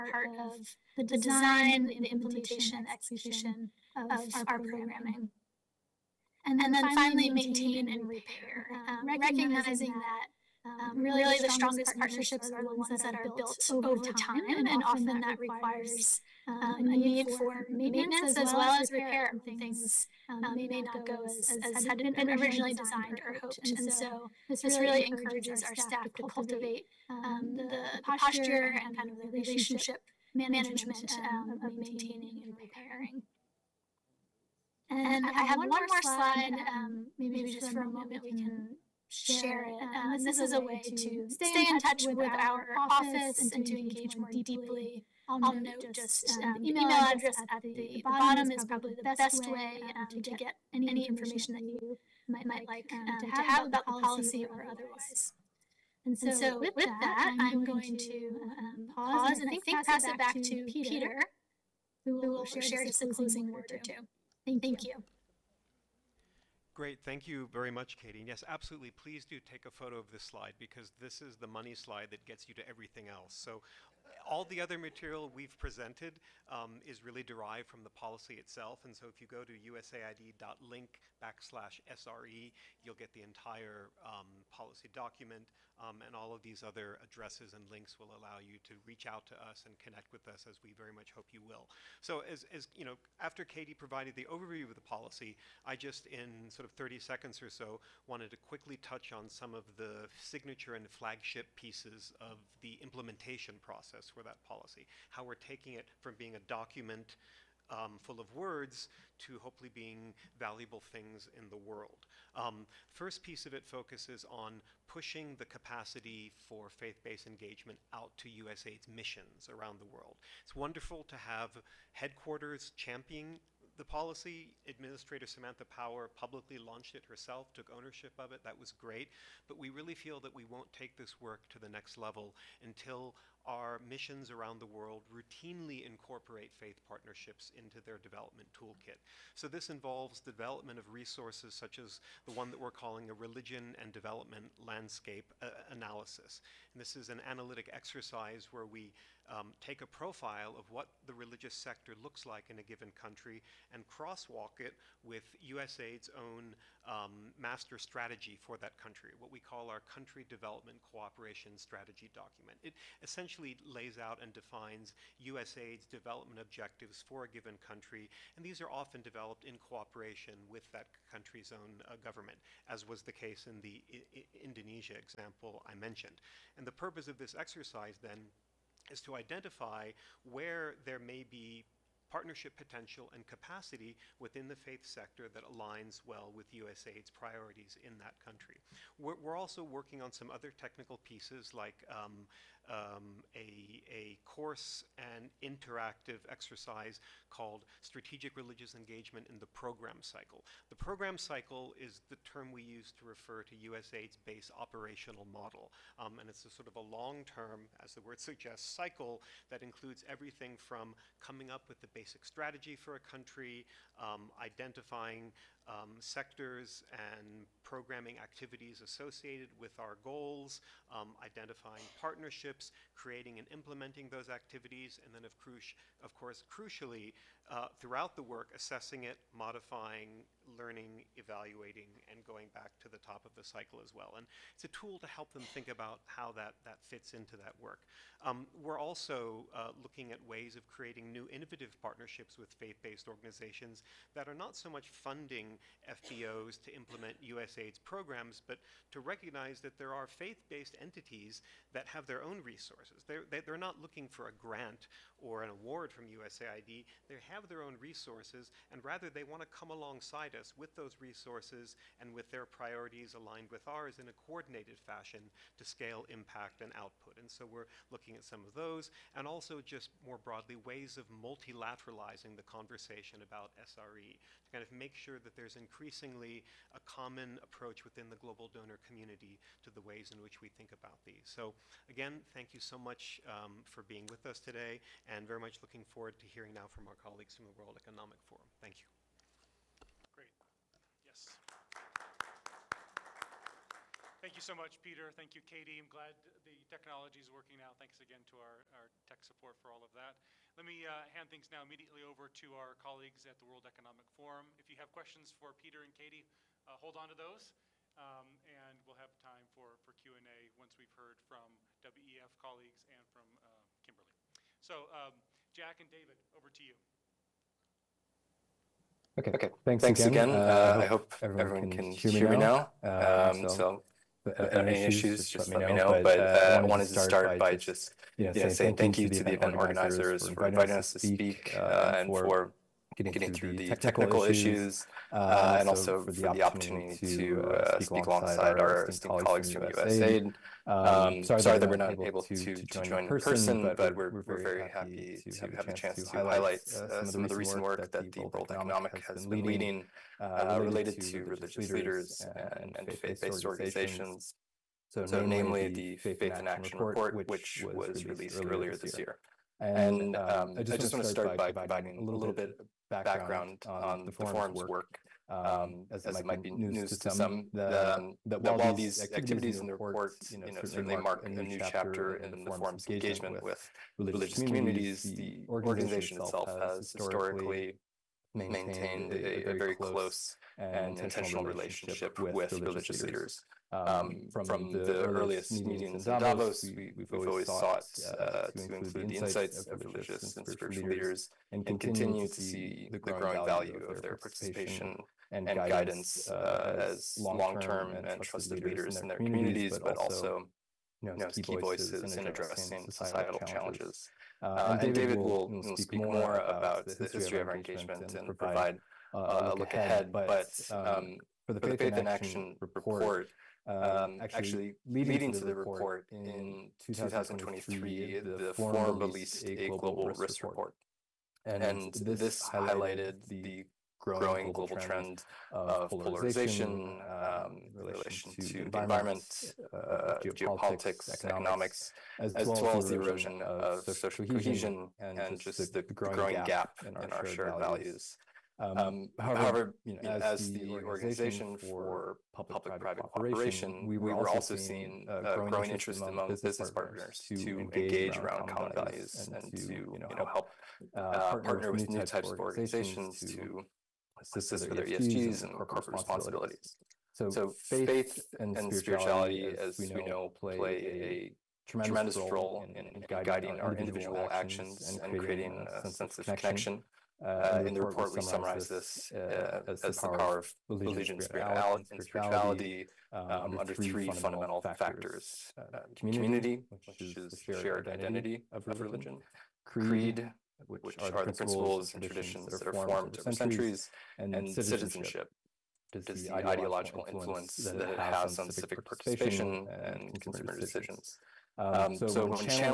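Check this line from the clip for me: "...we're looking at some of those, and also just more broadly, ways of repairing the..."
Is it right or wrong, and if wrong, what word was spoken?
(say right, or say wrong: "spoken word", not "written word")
wrong: "multilateralizing", not "repairing".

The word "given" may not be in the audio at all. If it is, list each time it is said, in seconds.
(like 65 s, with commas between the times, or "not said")
152 s, 167 s.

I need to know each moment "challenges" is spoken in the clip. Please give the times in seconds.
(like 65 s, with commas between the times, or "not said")
403 s.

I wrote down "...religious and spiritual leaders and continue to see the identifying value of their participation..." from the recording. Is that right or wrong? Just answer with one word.
wrong.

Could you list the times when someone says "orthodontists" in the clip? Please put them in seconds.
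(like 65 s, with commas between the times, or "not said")
not said.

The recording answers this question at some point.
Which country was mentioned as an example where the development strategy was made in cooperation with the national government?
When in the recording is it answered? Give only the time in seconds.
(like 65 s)
174 s.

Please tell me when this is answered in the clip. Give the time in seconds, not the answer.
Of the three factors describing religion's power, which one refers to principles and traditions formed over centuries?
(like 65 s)
479 s.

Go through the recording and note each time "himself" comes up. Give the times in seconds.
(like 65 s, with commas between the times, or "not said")
not said.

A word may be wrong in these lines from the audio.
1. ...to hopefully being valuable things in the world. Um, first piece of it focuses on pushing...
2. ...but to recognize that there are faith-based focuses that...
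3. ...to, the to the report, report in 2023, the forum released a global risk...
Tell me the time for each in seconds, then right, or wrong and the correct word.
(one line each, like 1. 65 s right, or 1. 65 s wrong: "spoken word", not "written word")
1. 109 s right
2. 248 s wrong: "entities", not "focuses"
3. 415 s right.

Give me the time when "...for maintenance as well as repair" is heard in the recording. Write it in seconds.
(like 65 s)
17 s.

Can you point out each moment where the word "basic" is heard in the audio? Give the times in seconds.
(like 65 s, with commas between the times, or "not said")
211 s.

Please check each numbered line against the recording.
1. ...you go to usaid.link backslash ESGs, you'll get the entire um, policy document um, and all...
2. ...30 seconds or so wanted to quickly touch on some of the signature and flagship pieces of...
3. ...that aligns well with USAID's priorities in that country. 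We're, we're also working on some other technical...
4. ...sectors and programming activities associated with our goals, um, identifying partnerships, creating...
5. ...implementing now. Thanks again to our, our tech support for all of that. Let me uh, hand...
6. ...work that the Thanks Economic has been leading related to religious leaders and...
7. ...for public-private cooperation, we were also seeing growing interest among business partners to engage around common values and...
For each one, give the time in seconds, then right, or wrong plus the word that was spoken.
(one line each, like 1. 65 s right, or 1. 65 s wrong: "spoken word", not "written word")
1. 79 s wrong: "SRE", not "ESGs"
2. 96 s right
3. 185 s right
4. 216 s right
5. 297 s wrong: "working", not "implementing"
6. 347 s wrong: "World", not "Thanks"
7. 441 s right.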